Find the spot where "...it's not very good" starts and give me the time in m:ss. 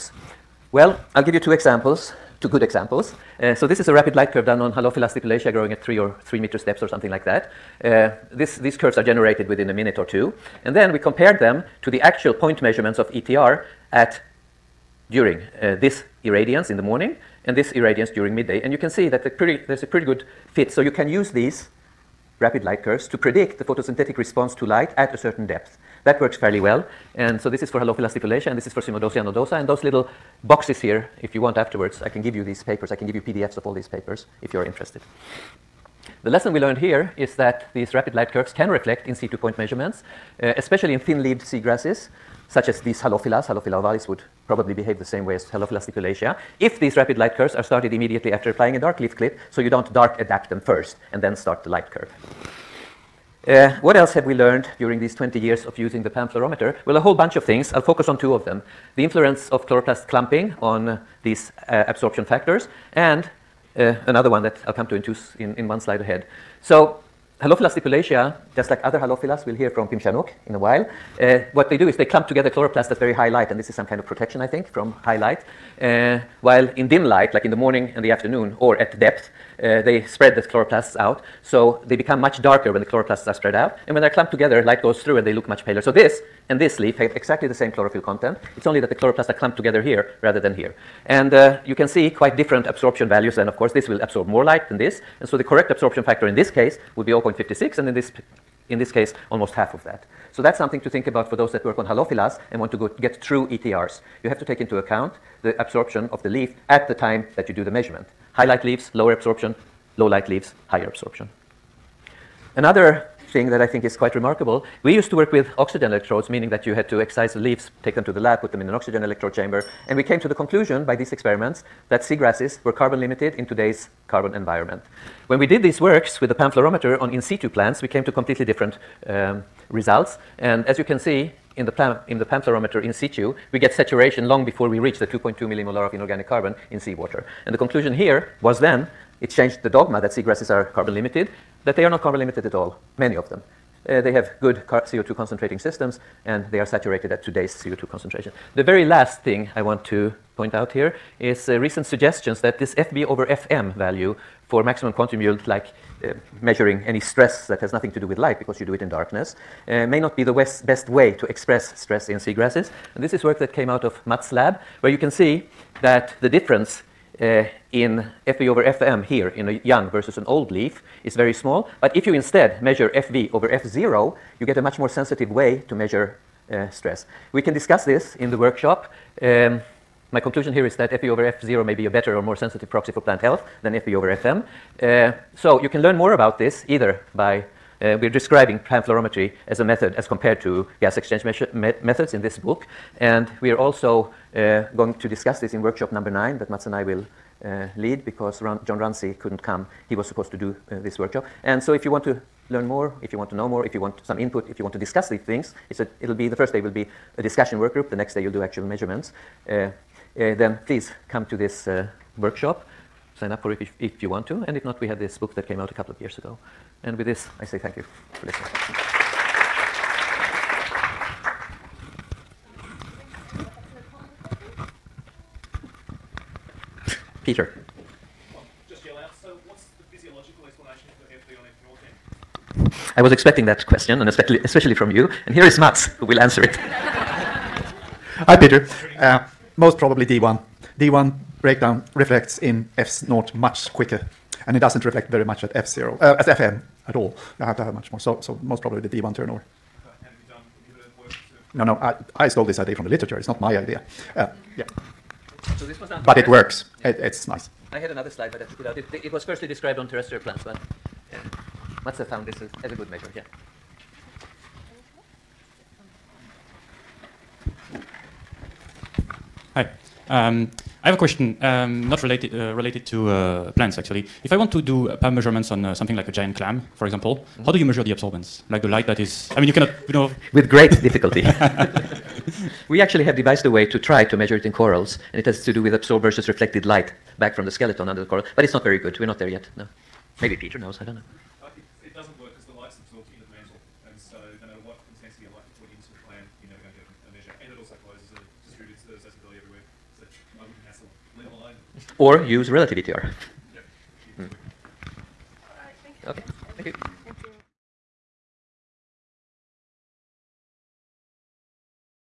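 4:48.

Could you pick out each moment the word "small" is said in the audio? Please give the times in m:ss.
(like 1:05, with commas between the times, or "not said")
2:51.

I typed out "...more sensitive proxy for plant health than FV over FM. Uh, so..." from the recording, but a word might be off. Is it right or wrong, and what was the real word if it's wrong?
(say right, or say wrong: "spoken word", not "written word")
right.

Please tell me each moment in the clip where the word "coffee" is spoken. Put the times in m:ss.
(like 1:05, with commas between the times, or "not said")
not said.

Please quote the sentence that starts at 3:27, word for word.
The next day you'll do actual measurements.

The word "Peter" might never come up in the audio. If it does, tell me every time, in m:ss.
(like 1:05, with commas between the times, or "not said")
3:47, 3:58, 4:50.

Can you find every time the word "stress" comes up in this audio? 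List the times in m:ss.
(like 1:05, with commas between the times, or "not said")
2:36, 2:41, 2:56.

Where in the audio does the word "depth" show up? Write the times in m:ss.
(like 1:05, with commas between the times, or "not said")
0:25, 1:18.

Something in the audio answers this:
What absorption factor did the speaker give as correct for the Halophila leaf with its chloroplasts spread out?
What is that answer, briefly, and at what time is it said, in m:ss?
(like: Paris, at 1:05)
0.56, at 1:37.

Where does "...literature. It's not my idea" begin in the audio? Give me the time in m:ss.
4:12.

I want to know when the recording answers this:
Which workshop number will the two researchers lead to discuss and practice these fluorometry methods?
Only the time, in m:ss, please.
3:16.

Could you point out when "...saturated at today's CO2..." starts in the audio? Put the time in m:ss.
2:26.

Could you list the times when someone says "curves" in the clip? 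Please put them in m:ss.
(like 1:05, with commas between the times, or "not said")
0:04, 0:08, 0:22, 0:38, 0:47, 0:51.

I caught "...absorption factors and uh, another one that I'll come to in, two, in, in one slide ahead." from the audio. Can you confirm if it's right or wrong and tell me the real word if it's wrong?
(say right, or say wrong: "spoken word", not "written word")
right.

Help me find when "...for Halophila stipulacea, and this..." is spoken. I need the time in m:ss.
0:27.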